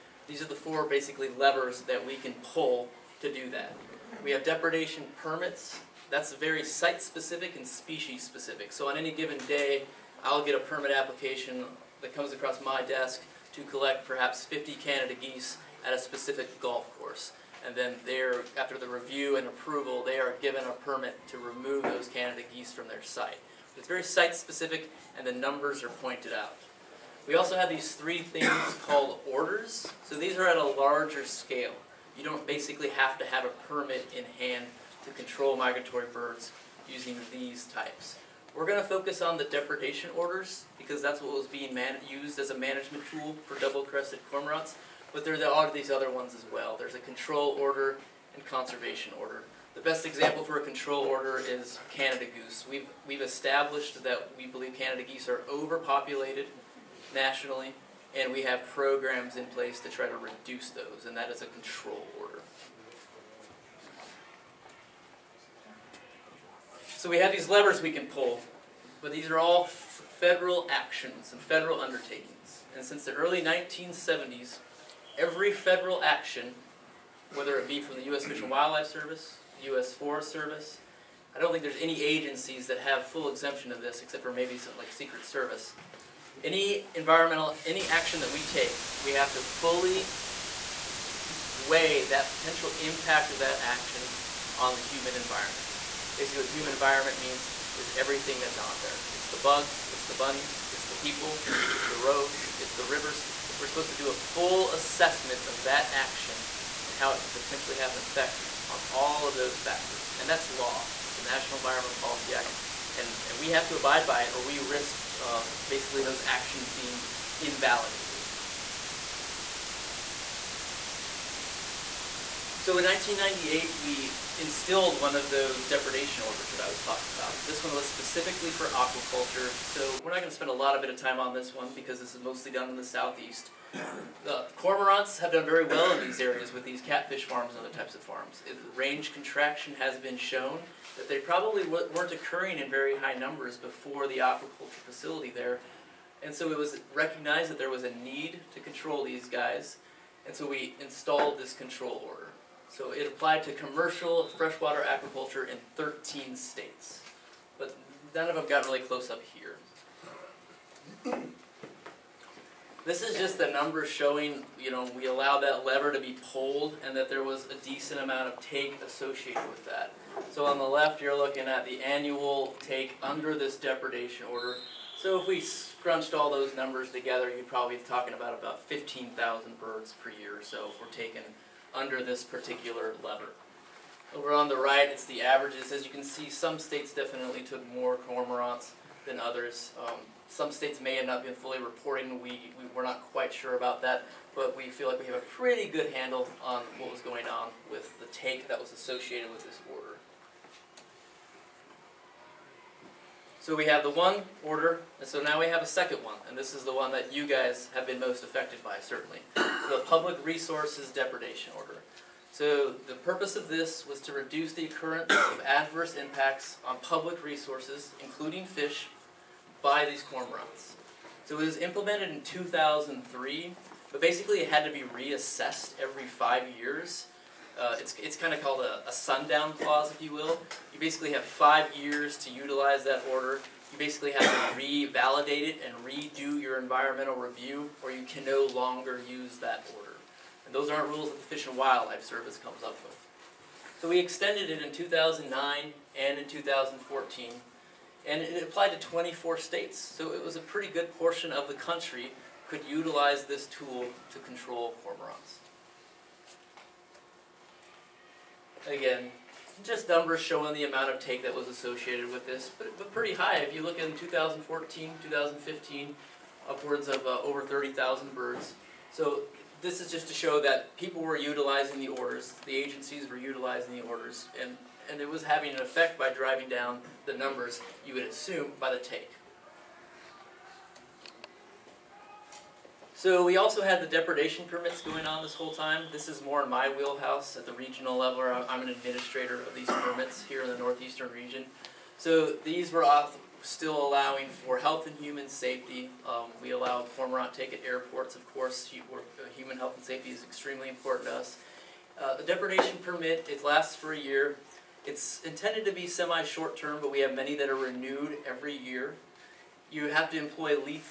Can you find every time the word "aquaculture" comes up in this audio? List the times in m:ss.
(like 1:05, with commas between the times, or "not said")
2:08, 2:24, 2:34.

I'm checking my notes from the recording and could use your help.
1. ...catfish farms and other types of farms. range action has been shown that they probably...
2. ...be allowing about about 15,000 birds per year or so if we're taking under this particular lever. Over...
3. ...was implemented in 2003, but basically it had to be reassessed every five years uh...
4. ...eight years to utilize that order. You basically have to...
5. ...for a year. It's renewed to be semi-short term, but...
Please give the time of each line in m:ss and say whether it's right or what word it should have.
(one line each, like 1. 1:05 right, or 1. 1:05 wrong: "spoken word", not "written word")
1. 2:16 wrong: "contraction", not "action"
2. 2:57 wrong: "talking", not "allowing"
3. 3:41 right
4. 3:51 wrong: "five", not "eight"
5. 5:03 wrong: "intended", not "renewed".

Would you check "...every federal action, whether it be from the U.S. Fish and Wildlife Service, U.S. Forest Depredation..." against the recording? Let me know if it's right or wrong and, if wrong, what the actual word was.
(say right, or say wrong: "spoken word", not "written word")
wrong: "Service", not "Depredation".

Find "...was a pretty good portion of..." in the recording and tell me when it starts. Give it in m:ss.
4:10.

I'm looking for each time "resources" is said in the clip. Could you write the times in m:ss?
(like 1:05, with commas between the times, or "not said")
3:30, 3:37.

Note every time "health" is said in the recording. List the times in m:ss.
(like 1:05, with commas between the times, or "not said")
4:54, 4:59.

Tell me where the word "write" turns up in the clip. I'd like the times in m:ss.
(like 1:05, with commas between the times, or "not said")
not said.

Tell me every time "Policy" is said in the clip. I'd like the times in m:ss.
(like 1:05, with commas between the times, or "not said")
1:52.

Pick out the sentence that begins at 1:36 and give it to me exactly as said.
Basically, the human environment means is everything that's out there.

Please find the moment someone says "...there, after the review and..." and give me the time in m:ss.
0:18.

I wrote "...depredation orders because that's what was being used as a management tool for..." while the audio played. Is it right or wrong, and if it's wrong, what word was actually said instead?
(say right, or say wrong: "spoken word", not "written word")
right.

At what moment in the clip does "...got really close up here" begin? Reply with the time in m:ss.
2:38.